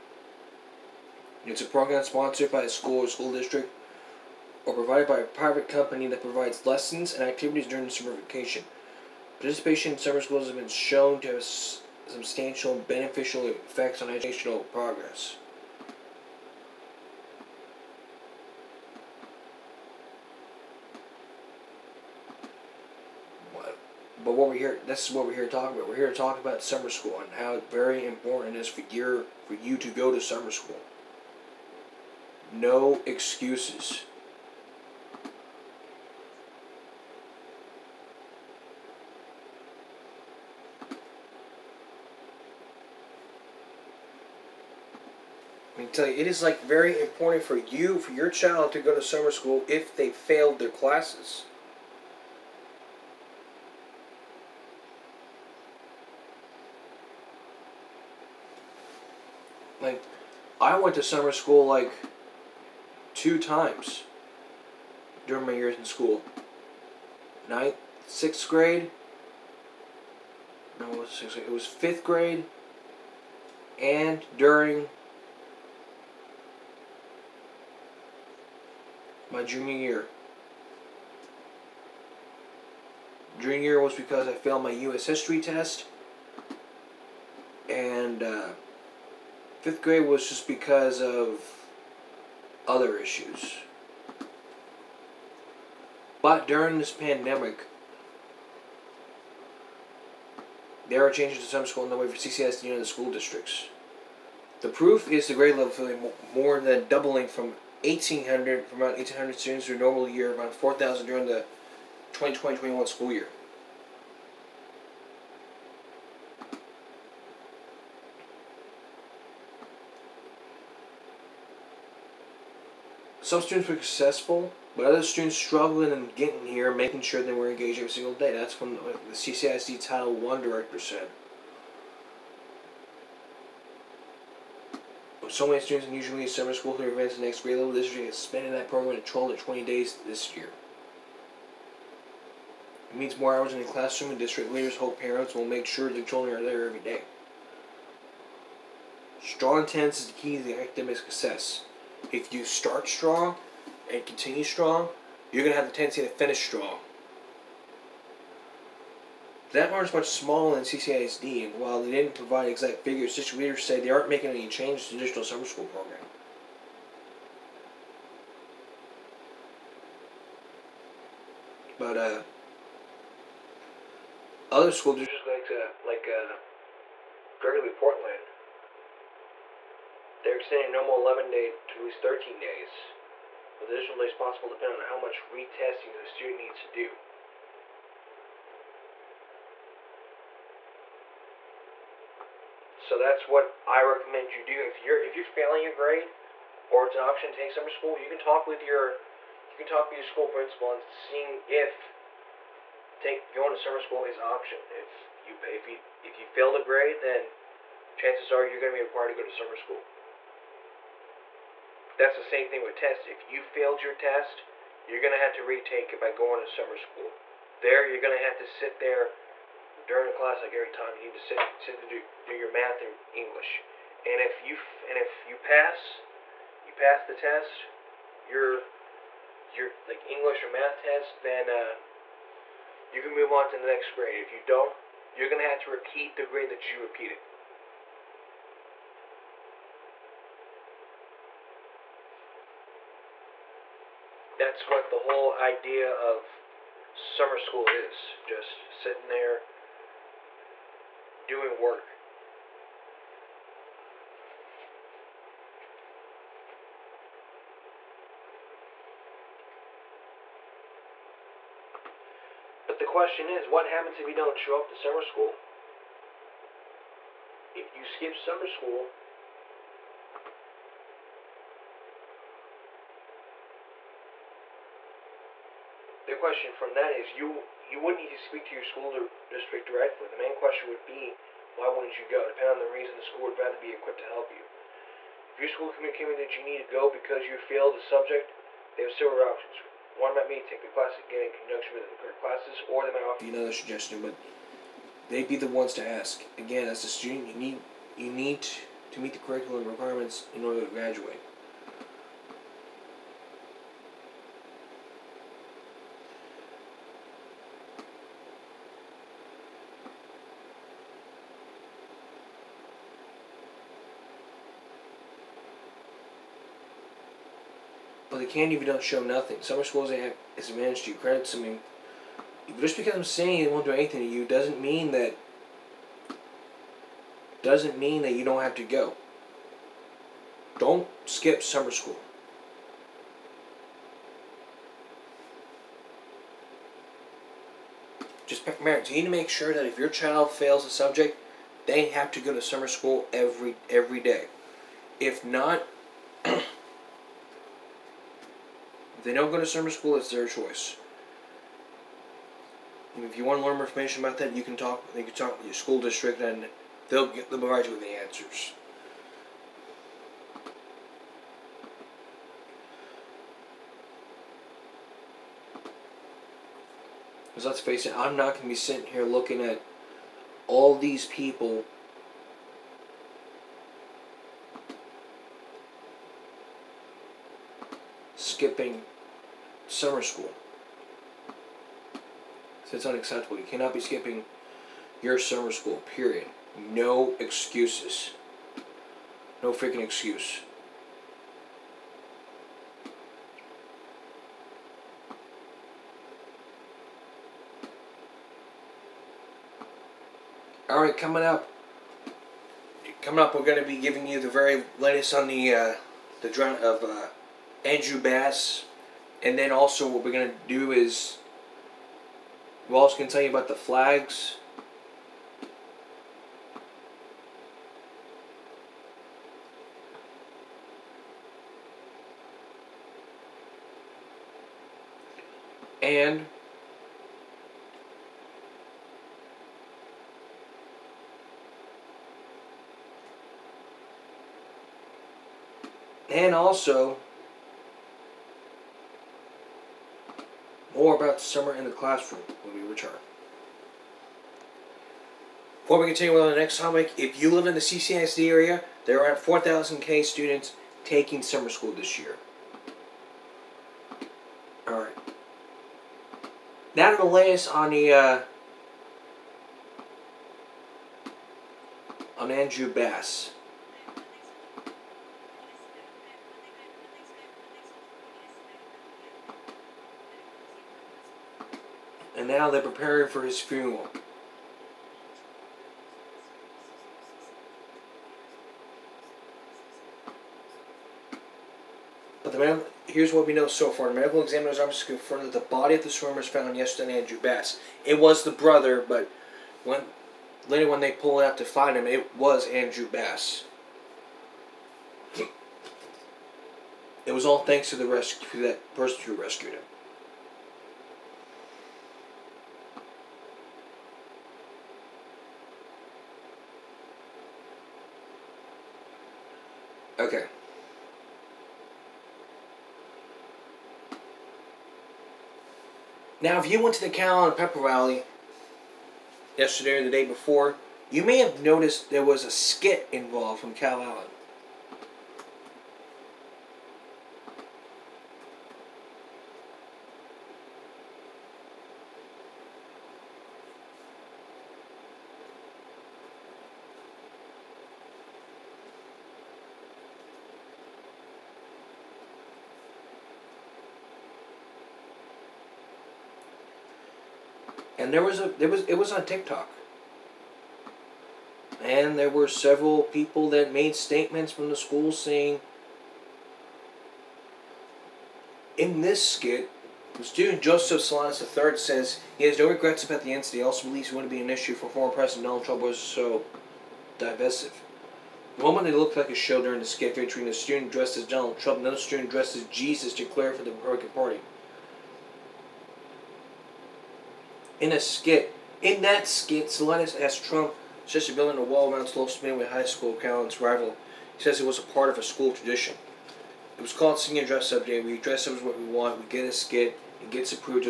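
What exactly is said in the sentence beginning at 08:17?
It was all thanks to the rescue that person who rescued him.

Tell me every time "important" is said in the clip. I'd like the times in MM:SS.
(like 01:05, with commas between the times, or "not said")
00:28, 00:47.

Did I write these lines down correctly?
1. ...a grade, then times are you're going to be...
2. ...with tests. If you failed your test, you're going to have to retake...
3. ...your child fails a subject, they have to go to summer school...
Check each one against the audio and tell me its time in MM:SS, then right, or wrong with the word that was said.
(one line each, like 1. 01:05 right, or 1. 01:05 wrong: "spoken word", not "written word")
1. 03:26 wrong: "chances", not "times"
2. 03:32 right
3. 05:39 right.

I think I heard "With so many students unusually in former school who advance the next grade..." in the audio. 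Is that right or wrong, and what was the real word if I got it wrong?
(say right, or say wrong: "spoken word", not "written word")
wrong: "summer", not "former".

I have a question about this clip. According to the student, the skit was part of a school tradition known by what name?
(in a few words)
Senior Dress Up Day.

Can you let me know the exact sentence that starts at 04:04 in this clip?
that's what the whole idea of summer school is just sitting there doing work.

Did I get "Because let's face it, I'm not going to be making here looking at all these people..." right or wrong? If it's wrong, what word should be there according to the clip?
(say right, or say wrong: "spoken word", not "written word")
wrong: "sitting", not "making".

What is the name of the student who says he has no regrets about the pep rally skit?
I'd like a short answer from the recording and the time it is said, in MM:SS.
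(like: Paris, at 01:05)
Joseph Salinas III, at 09:20.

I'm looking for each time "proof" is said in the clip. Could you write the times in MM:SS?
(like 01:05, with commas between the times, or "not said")
01:44.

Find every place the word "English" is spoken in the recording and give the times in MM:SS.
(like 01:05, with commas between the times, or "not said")
03:43, 03:50.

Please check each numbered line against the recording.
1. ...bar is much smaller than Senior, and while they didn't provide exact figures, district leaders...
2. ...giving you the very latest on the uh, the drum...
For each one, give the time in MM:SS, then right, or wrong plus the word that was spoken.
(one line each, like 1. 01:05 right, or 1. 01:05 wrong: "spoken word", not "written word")
1. 02:39 wrong: "CCISD", not "Senior"
2. 06:43 right.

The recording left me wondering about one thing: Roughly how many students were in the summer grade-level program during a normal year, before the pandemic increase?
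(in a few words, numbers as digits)
1,800.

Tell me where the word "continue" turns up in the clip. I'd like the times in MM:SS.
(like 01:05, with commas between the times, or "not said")
02:34, 07:25.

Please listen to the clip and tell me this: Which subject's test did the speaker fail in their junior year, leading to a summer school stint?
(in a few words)
U.S. history.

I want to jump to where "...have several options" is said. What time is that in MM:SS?
04:48.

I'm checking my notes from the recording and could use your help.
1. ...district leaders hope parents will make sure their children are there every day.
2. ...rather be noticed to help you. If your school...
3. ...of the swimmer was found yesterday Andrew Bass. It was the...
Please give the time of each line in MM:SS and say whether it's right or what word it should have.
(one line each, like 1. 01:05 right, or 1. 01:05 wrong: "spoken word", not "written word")
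1. 02:24 right
2. 04:43 wrong: "equipped", not "noticed"
3. 08:05 right.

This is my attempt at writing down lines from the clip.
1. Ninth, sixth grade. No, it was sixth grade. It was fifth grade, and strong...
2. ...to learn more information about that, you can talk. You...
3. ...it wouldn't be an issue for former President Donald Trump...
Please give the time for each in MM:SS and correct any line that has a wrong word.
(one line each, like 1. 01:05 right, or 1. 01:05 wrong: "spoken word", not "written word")
1. 01:07 wrong: "during", not "strong"
2. 05:53 right
3. 09:23 right.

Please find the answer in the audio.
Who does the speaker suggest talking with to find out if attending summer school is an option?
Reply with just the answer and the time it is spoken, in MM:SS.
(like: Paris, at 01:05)
school principal, at 03:20.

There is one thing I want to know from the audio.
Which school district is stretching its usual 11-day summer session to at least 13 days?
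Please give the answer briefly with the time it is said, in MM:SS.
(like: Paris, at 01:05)
Gregory Portland, at 02:57.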